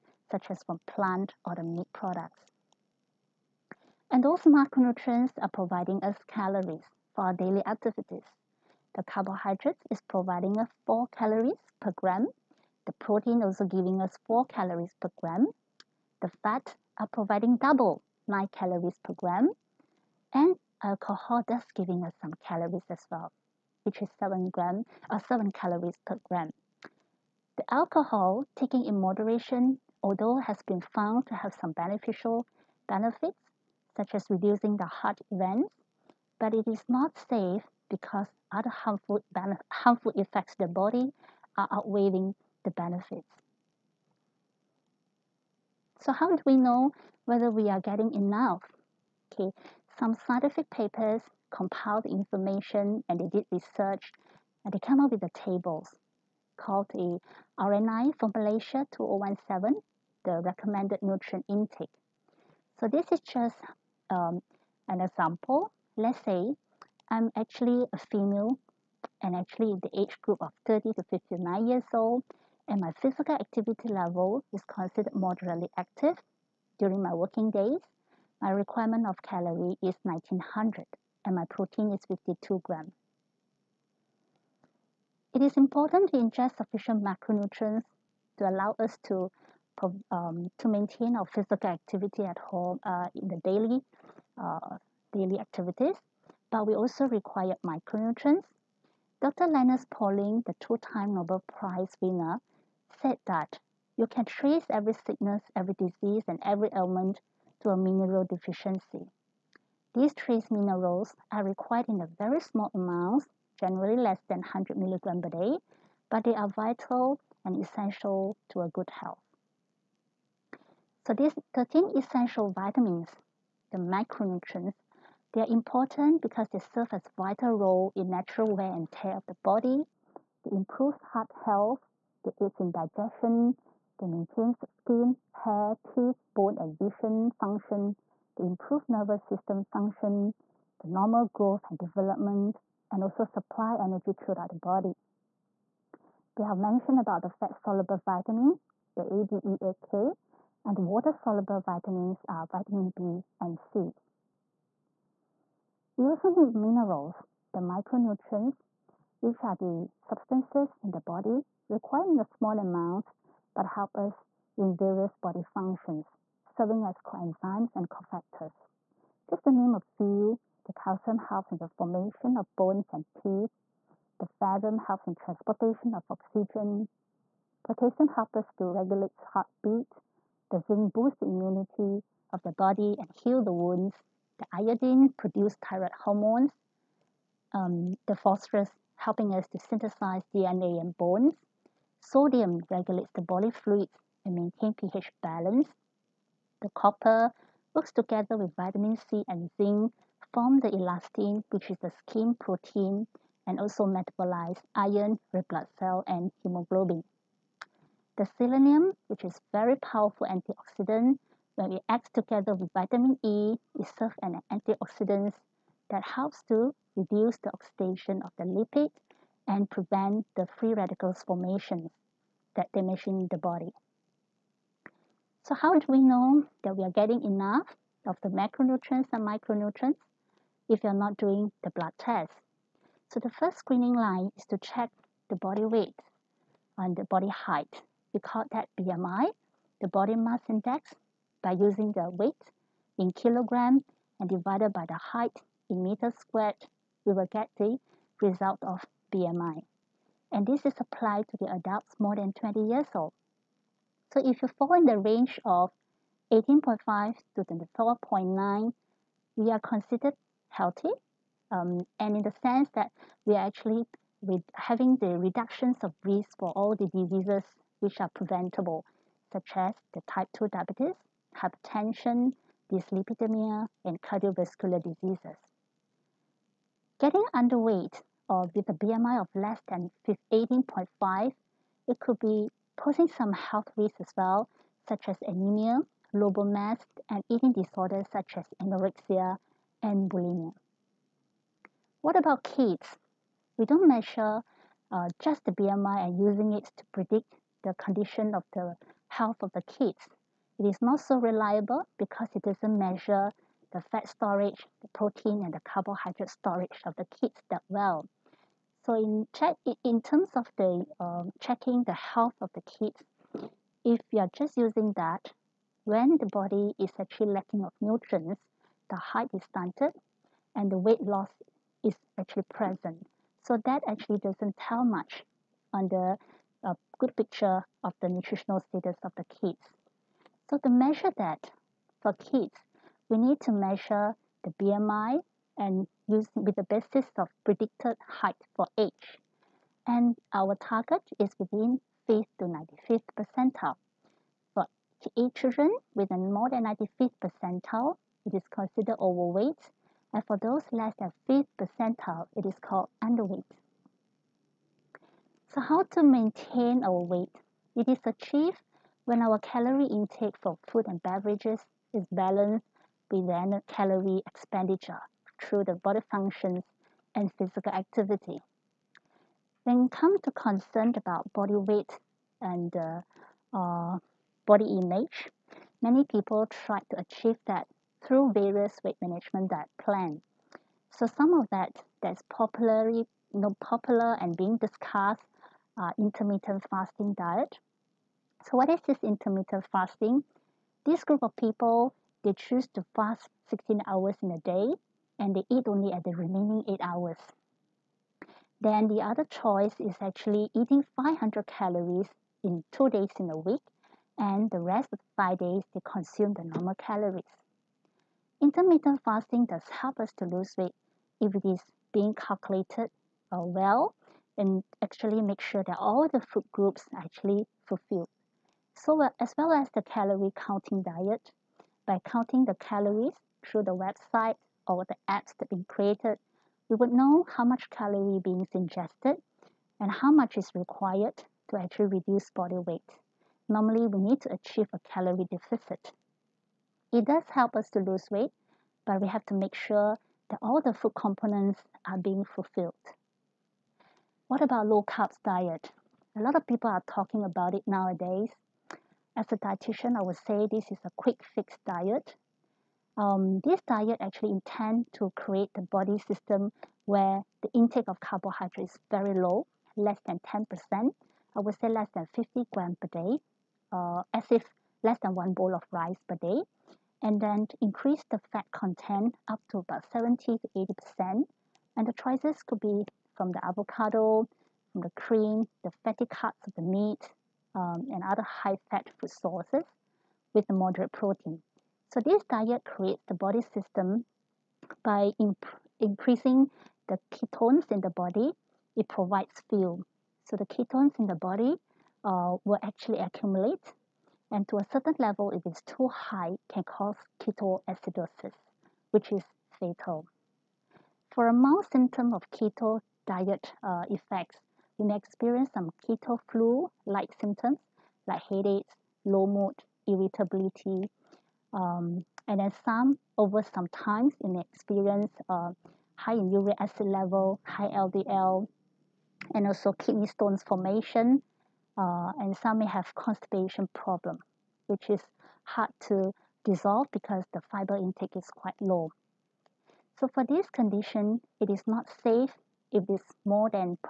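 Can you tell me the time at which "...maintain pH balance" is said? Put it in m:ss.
3:14.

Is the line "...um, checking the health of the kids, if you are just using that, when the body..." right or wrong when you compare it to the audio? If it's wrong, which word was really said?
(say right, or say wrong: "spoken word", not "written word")
right.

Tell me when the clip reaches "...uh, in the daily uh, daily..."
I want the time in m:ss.
1:32.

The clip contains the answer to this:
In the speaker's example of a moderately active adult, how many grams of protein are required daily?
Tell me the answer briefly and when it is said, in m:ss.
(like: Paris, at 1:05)
52 grams, at 1:22.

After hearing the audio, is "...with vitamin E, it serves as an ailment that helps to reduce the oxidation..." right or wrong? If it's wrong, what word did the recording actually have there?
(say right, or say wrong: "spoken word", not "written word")
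wrong: "antioxidant", not "ailment".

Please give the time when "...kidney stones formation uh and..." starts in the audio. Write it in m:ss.
8:39.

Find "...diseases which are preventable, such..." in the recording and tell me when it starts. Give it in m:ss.
4:26.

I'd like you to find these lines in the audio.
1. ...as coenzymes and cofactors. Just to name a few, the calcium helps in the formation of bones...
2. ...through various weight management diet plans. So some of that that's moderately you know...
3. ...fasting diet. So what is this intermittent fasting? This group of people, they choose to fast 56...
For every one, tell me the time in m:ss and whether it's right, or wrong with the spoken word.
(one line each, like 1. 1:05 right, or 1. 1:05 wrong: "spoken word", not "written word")
1. 2:46 right
2. 6:18 wrong: "popularly", not "moderately"
3. 6:26 wrong: "16", not "56".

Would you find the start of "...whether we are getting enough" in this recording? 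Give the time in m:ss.
0:47.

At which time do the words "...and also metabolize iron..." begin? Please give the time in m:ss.
3:23.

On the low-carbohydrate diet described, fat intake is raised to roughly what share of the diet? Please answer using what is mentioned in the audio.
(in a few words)
70 to 80%.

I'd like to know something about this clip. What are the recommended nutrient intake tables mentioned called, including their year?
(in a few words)
RNI 2017.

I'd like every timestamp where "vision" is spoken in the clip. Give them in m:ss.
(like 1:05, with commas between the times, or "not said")
2:16.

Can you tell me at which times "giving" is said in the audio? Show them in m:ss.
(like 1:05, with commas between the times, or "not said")
0:13, 0:21.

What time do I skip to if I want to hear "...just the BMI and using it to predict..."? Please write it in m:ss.
4:55.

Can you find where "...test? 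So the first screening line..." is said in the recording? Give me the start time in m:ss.
3:51.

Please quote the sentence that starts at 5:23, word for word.
So that actually doesn't tell much on the a good picture of the nutritional status of the kids.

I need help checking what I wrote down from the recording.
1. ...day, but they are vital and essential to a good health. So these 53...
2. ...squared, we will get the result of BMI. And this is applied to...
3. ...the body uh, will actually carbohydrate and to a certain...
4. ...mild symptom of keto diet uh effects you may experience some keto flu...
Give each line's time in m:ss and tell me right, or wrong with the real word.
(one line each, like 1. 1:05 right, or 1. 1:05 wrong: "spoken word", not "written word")
1. 1:55 wrong: "13", not "53"
2. 4:06 right
3. 8:11 wrong: "accumulate", not "carbohydrate"
4. 8:21 right.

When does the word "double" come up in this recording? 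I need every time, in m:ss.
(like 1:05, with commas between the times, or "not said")
0:17.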